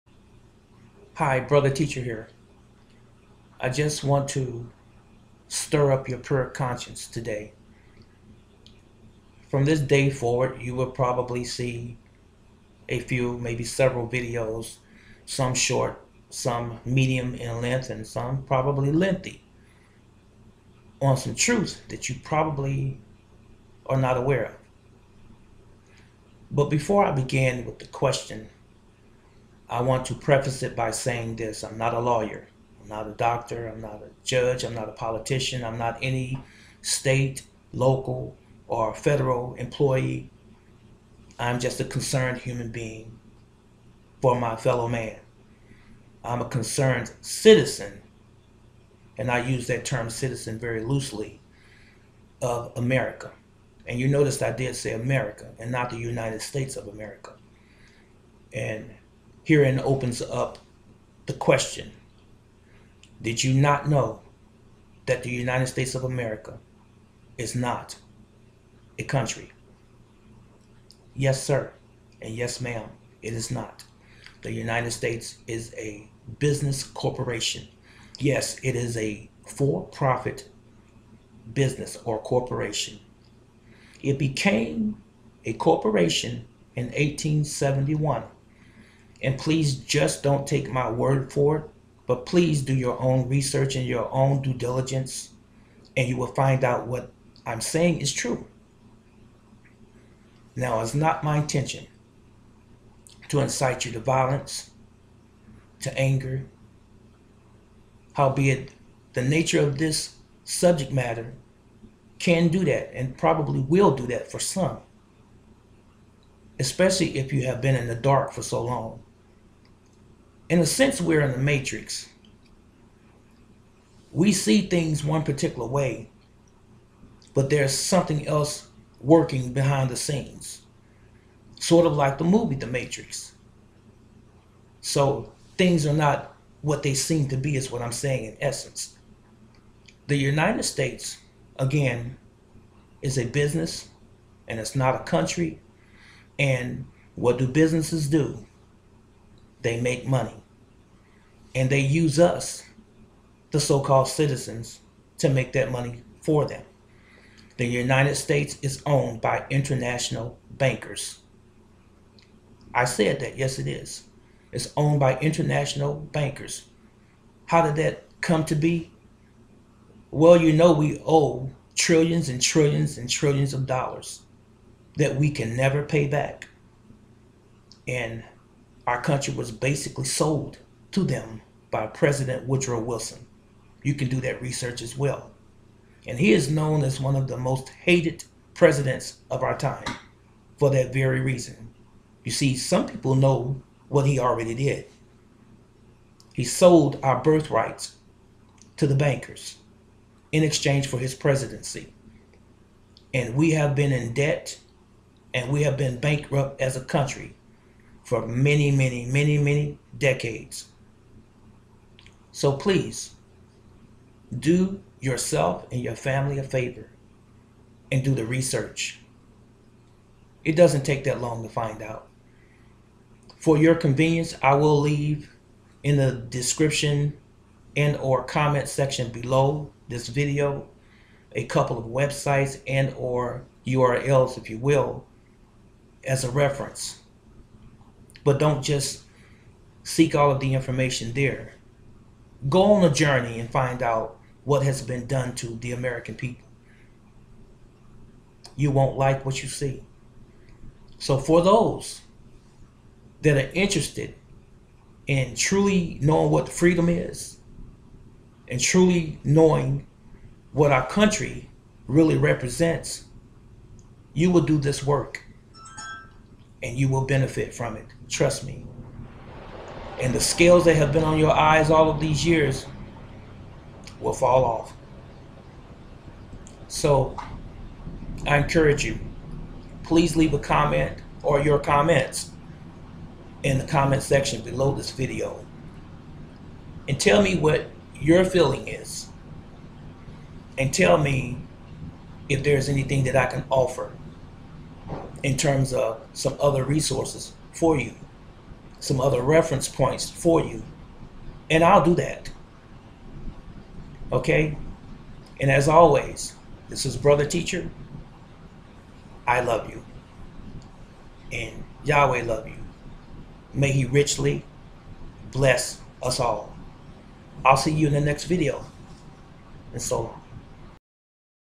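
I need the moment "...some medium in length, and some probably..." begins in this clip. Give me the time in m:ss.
0:16.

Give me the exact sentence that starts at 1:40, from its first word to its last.
Now, it's not my intention to incite you to violence, to anger.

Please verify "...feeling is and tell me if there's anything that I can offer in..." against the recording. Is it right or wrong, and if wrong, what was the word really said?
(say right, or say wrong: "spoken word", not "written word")
right.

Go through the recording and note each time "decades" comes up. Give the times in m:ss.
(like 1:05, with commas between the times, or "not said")
3:29.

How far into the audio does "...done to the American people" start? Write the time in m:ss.
4:05.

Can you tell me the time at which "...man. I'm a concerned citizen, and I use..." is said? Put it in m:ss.
0:44.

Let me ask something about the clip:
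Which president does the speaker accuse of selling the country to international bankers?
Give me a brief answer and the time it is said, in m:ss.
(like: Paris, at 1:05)
Woodrow Wilson, at 3:02.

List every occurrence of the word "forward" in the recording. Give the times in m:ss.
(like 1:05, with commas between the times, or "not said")
0:10.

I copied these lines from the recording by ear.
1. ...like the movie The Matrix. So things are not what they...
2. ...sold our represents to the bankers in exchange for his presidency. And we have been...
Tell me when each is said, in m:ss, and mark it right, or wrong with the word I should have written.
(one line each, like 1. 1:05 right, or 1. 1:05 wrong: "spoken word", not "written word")
1. 2:11 right
2. 3:16 wrong: "birthrights", not "represents".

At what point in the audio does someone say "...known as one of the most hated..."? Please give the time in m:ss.
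3:06.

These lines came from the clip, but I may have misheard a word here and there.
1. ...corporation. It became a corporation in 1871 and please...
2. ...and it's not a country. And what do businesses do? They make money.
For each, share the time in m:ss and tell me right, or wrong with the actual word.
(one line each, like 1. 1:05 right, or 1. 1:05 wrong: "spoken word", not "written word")
1. 1:22 right
2. 2:24 right.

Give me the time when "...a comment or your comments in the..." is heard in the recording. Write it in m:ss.
4:40.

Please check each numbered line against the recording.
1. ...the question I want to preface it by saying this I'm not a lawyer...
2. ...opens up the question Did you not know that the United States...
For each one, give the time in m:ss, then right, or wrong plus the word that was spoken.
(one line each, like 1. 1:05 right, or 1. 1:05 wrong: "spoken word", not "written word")
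1. 0:27 right
2. 0:59 right.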